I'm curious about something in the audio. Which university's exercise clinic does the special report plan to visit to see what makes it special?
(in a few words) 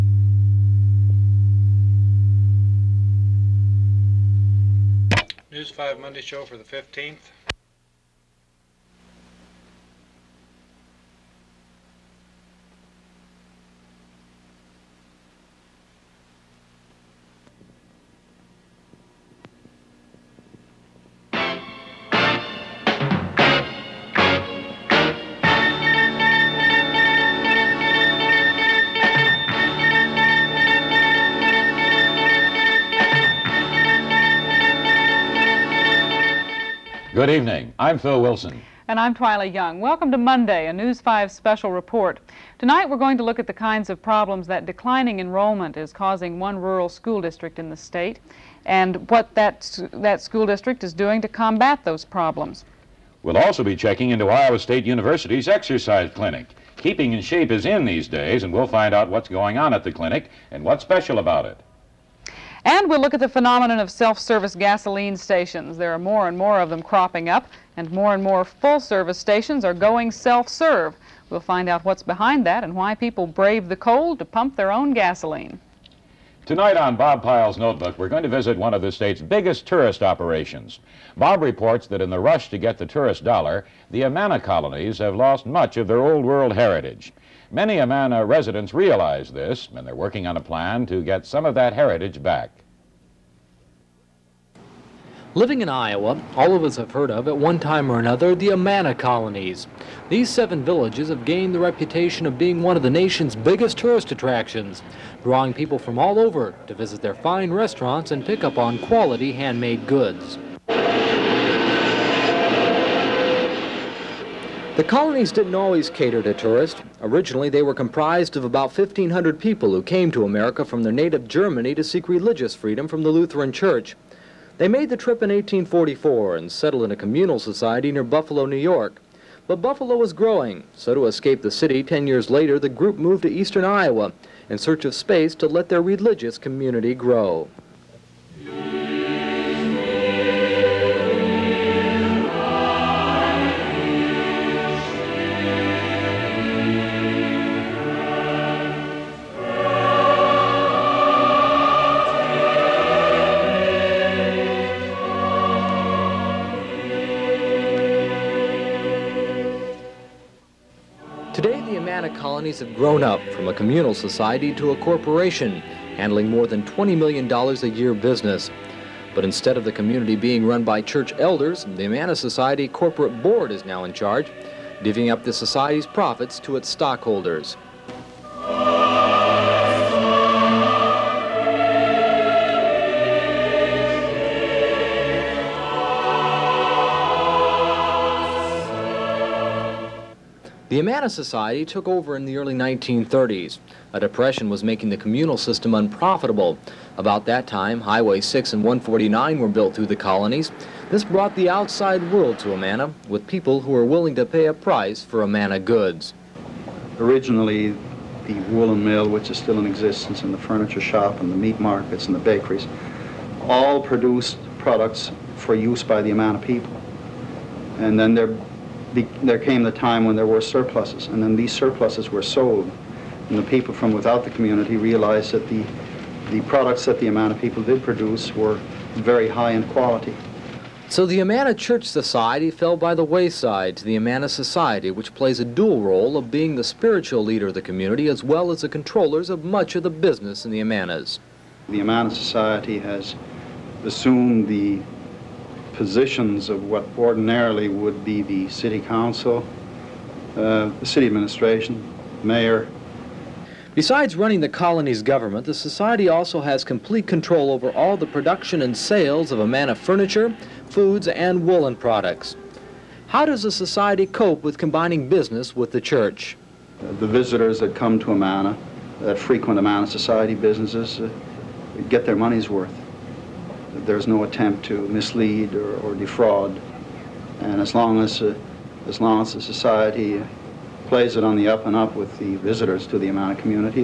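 Iowa State University.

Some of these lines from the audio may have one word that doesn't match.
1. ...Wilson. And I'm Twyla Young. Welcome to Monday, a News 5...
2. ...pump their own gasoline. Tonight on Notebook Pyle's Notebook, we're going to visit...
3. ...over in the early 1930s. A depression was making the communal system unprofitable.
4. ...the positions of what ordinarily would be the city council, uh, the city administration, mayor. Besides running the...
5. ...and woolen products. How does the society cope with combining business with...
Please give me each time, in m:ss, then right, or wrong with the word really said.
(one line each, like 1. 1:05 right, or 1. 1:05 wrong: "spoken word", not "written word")
1. 0:38 right
2. 1:14 wrong: "Bob", not "Notebook"
3. 3:11 right
4. 4:04 right
5. 4:21 right.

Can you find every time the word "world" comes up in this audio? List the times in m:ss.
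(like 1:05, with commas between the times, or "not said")
1:26, 3:22.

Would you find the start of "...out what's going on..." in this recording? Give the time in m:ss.
0:58.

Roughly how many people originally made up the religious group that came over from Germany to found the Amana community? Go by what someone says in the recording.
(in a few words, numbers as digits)
1,500.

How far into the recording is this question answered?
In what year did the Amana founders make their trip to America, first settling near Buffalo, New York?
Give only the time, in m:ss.
2:05.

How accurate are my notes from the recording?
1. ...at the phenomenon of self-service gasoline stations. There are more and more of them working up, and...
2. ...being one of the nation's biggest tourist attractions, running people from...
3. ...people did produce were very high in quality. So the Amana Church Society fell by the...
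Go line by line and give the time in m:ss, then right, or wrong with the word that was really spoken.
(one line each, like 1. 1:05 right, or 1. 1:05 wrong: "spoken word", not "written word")
1. 1:03 wrong: "cropping", not "working"
2. 1:42 wrong: "drawing", not "running"
3. 3:47 right.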